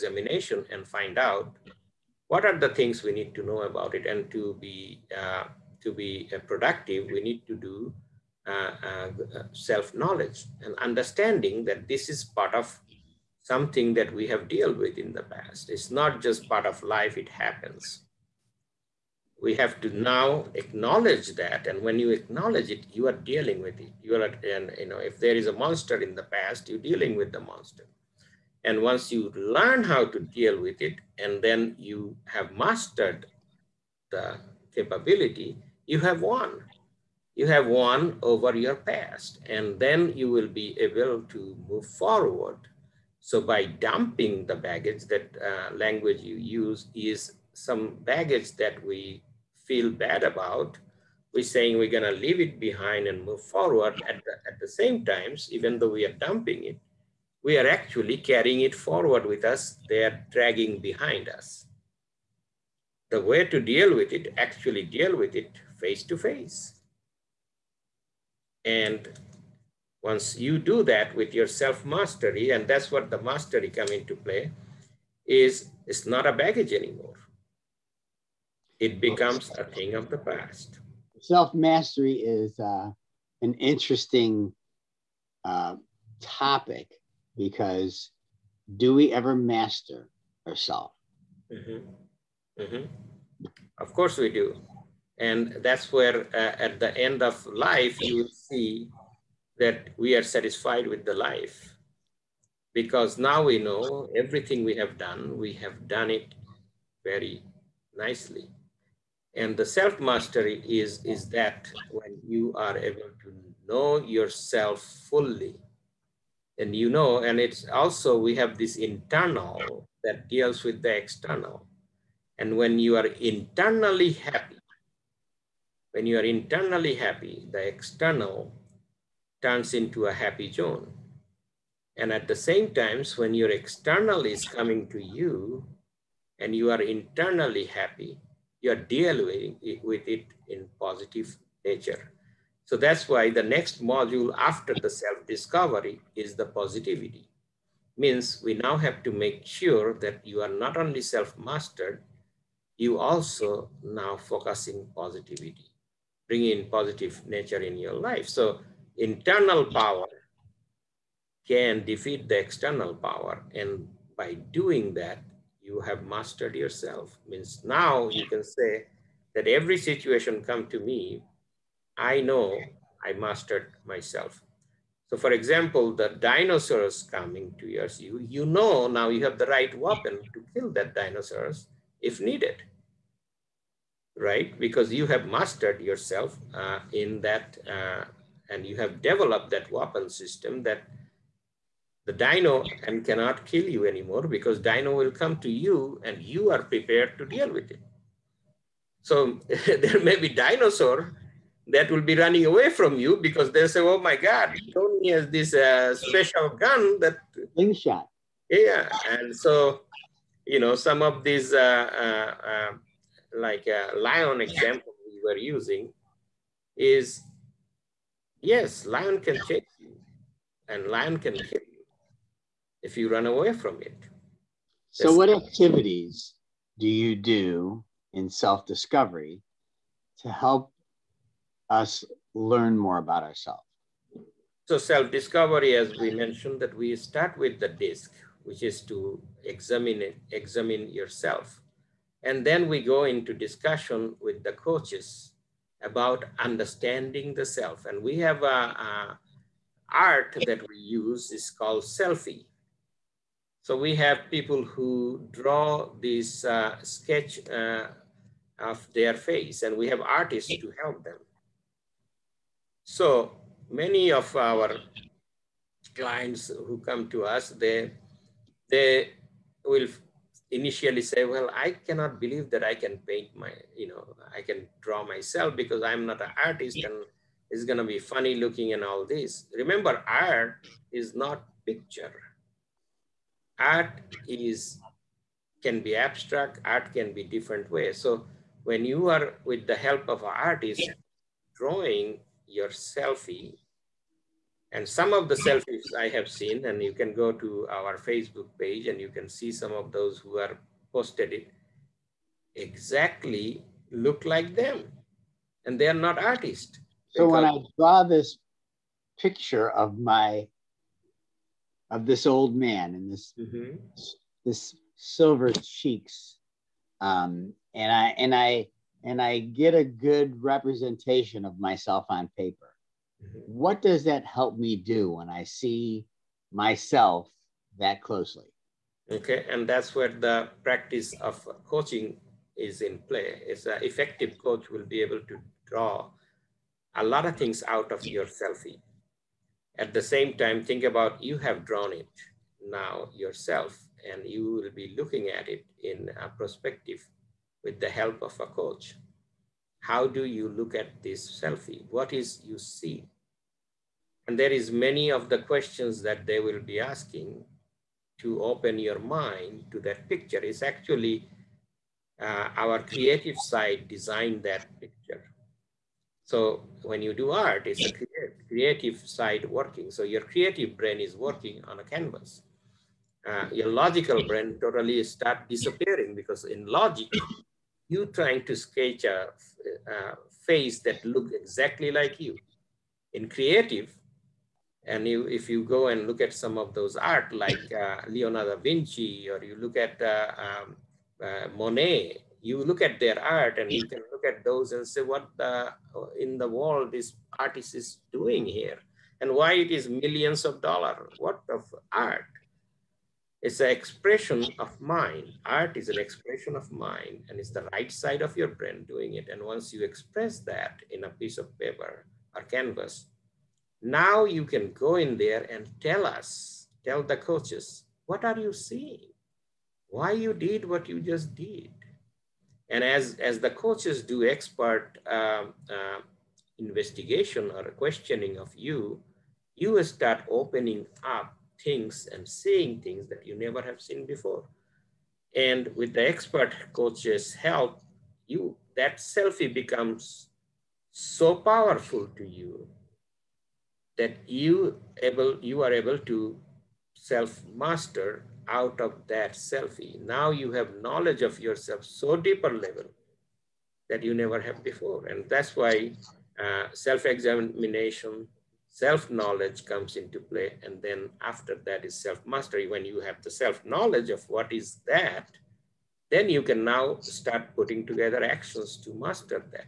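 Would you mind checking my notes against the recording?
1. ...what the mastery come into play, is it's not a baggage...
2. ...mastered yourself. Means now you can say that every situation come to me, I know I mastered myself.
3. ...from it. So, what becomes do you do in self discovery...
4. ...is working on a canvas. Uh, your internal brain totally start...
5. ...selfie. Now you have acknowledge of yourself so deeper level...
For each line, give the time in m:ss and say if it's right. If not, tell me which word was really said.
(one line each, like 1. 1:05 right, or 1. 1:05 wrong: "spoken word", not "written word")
1. 1:12 right
2. 2:46 right
3. 3:43 wrong: "activities", not "becomes"
4. 6:10 wrong: "logical", not "internal"
5. 7:29 wrong: "knowledge", not "acknowledge".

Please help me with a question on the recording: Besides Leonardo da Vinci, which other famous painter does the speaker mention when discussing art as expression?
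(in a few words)
Monet.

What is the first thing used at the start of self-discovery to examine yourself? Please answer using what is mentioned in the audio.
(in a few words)
The disc.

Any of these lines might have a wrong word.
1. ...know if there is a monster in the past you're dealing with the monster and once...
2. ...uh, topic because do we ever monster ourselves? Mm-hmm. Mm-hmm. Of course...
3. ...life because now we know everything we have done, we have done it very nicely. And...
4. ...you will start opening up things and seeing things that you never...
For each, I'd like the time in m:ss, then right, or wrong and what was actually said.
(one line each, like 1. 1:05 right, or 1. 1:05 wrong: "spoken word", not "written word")
1. 0:24 right
2. 1:25 wrong: "master", not "monster"
3. 1:41 right
4. 7:09 right.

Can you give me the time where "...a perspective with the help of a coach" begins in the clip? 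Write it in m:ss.
5:46.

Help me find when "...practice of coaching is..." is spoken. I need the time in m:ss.
5:30.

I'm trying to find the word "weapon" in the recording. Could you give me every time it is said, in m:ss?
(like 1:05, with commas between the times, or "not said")
2:59, 3:09.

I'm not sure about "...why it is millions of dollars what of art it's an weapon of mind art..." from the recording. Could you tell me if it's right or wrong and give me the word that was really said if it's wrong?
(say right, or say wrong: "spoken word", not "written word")
wrong: "expression", not "weapon".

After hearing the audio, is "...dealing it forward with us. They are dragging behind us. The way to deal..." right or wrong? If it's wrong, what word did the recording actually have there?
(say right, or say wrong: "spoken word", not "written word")
wrong: "carrying", not "dealing".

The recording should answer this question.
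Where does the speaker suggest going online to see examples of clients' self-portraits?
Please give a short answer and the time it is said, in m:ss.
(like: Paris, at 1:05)
Facebook page, at 4:57.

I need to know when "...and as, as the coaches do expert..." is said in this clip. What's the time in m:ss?
7:02.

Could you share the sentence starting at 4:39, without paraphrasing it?
Remember, art is not picture art is can be abstract, art can be different ways.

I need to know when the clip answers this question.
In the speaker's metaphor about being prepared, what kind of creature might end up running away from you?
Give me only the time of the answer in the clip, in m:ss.
3:20.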